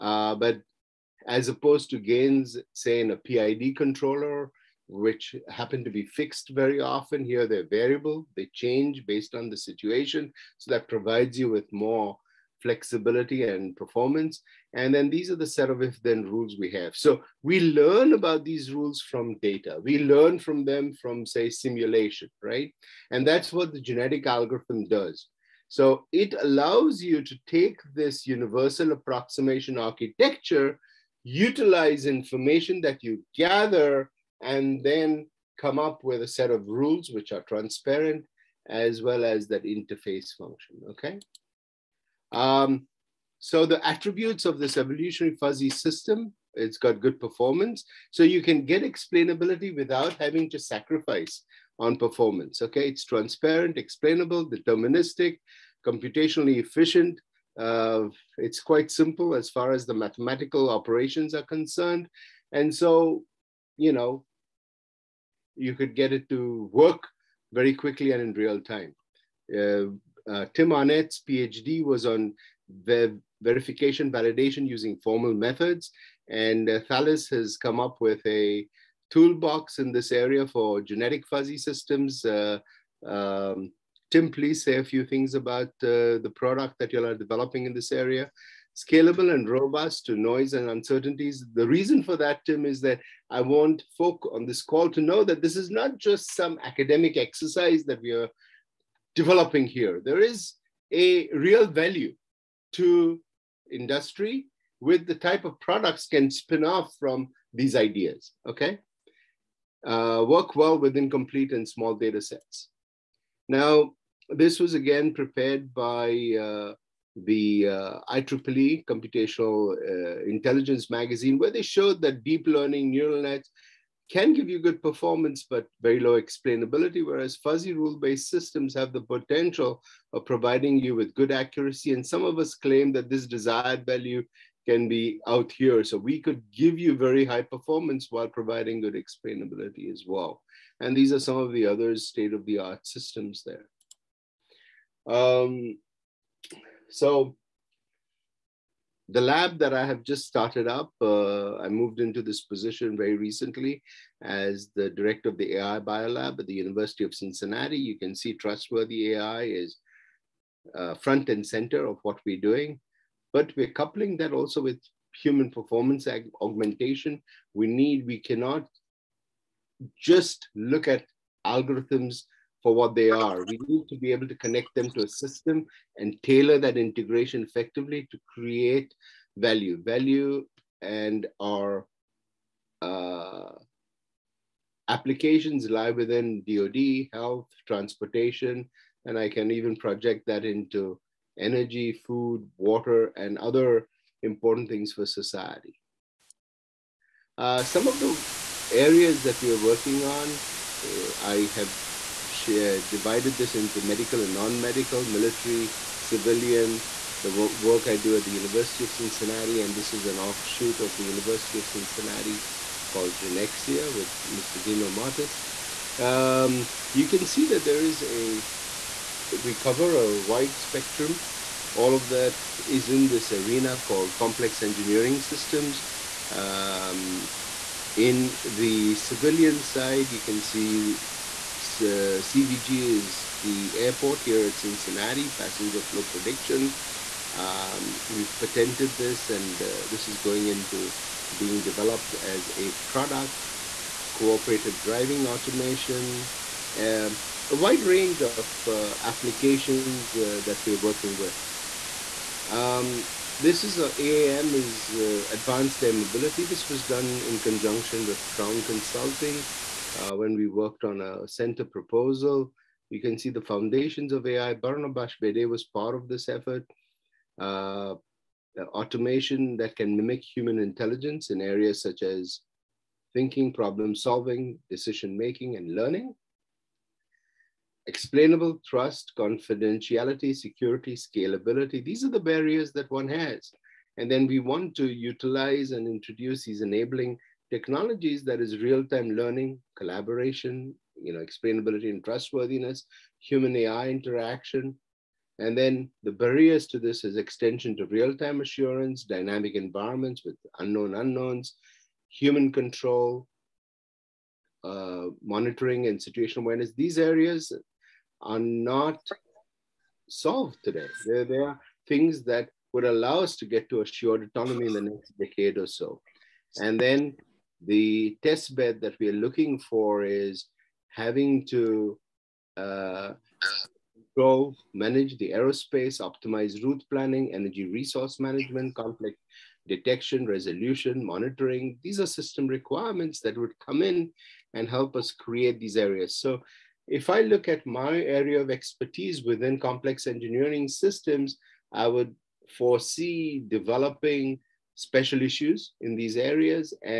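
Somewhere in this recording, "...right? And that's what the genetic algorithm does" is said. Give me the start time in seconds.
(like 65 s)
22 s.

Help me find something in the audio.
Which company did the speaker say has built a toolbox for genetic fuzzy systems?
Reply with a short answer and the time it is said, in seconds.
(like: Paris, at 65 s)
Thales, at 76 s.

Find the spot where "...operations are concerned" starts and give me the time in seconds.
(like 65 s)
60 s.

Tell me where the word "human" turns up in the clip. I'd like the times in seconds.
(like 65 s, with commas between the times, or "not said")
165 s, 270 s, 293 s, 302 s.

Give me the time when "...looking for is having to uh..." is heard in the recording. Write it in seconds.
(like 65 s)
319 s.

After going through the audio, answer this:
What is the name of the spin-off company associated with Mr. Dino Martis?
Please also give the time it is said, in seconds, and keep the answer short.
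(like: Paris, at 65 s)
Genexia, at 213 s.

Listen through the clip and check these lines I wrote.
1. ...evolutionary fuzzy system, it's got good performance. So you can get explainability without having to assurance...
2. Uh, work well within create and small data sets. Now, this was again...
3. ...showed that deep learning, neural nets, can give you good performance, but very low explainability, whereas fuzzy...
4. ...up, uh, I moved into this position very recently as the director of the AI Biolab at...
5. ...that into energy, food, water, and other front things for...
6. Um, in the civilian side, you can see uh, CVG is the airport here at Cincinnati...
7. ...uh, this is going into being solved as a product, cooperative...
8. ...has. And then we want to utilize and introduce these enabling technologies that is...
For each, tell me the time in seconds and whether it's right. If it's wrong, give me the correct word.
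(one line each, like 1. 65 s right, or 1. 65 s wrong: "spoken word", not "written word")
1. 44 s wrong: "sacrifice", not "assurance"
2. 109 s wrong: "complete", not "create"
3. 121 s right
4. 150 s right
5. 190 s wrong: "important", not "front"
6. 226 s right
7. 239 s wrong: "developed", not "solved"
8. 283 s right.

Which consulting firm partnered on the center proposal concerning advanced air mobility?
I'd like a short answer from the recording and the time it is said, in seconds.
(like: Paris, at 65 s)
Crown Consulting, at 258 s.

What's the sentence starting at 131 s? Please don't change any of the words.
And some of us claim that this desired value can be out here.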